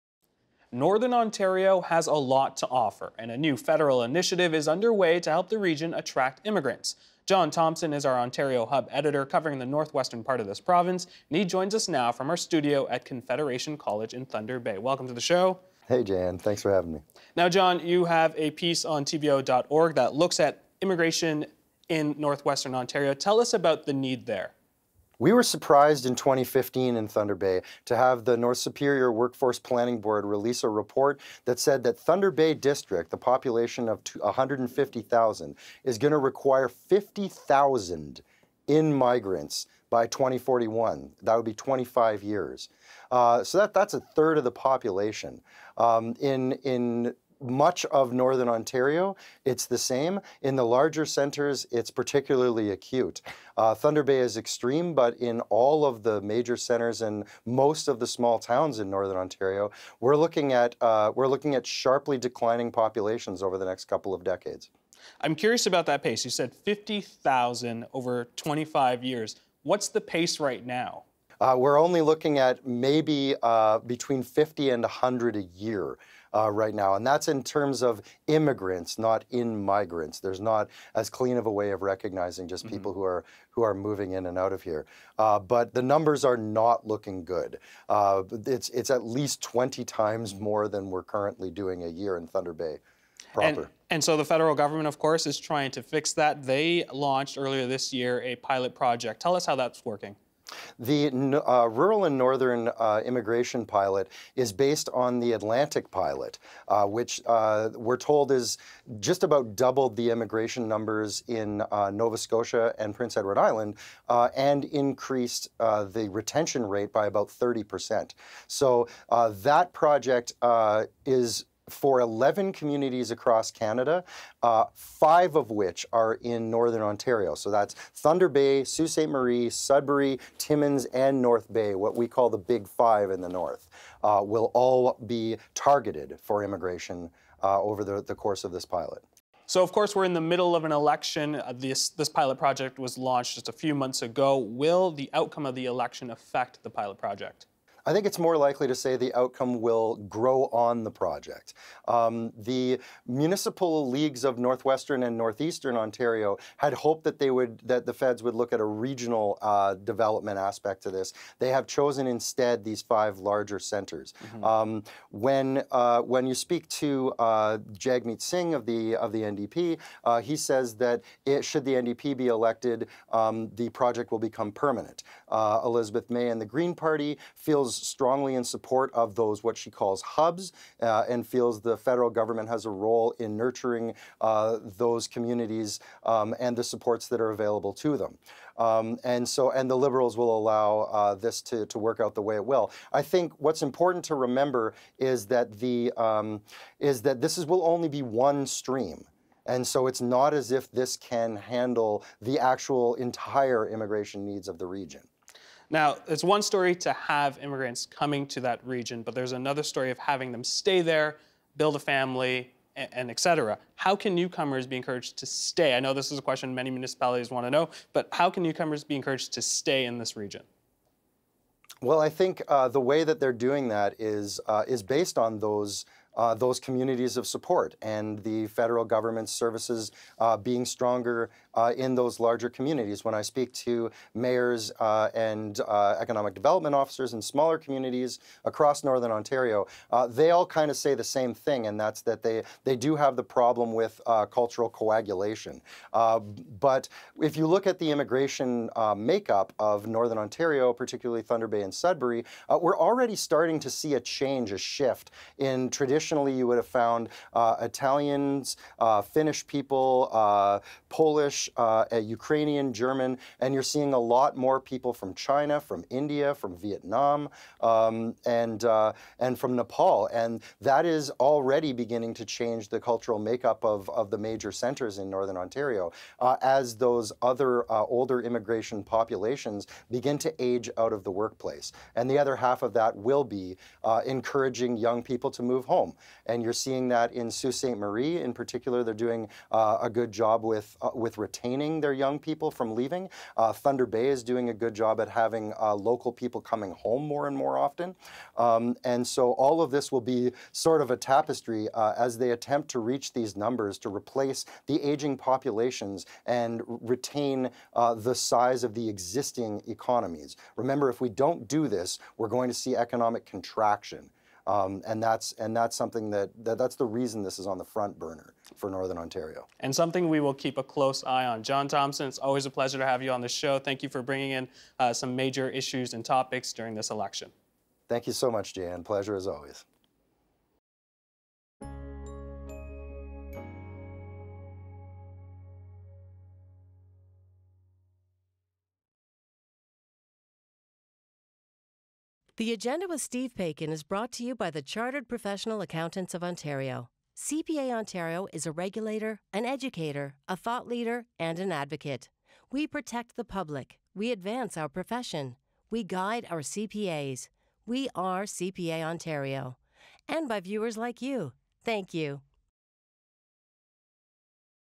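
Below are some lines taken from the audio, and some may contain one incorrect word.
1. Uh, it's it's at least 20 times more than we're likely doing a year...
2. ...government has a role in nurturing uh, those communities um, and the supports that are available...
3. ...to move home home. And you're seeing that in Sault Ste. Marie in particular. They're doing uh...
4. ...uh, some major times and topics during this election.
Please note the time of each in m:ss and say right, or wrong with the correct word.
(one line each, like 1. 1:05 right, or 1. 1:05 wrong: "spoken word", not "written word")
1. 1:27 wrong: "currently", not "likely"
2. 3:02 right
3. 4:45 right
4. 5:24 wrong: "issues", not "times".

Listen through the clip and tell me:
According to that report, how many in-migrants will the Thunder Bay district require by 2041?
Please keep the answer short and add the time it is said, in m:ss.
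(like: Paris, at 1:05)
50,000, at 0:36.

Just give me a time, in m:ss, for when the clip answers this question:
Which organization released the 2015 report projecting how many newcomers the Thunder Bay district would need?
0:28.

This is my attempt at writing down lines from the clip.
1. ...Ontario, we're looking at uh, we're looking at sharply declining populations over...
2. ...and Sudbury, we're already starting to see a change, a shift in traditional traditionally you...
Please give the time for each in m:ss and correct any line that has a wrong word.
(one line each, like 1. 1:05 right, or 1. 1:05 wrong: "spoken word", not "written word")
1. 0:59 right
2. 4:11 right.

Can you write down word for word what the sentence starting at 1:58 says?
So that project is for 11 communities across Canada, uh, five of which are in Northern Ontario.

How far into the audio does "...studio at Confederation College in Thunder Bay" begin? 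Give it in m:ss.
0:12.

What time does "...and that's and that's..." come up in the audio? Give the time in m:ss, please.
5:14.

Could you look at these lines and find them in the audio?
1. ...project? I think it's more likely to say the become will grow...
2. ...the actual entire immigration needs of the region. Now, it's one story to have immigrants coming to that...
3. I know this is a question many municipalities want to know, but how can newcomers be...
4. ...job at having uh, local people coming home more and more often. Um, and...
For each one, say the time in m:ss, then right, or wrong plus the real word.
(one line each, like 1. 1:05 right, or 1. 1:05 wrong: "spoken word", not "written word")
1. 2:26 wrong: "outcome", not "become"
2. 3:22 right
3. 3:35 right
4. 4:54 right.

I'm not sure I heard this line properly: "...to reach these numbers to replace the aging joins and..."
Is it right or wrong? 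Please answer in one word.
wrong.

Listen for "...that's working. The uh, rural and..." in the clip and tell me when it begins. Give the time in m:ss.
1:39.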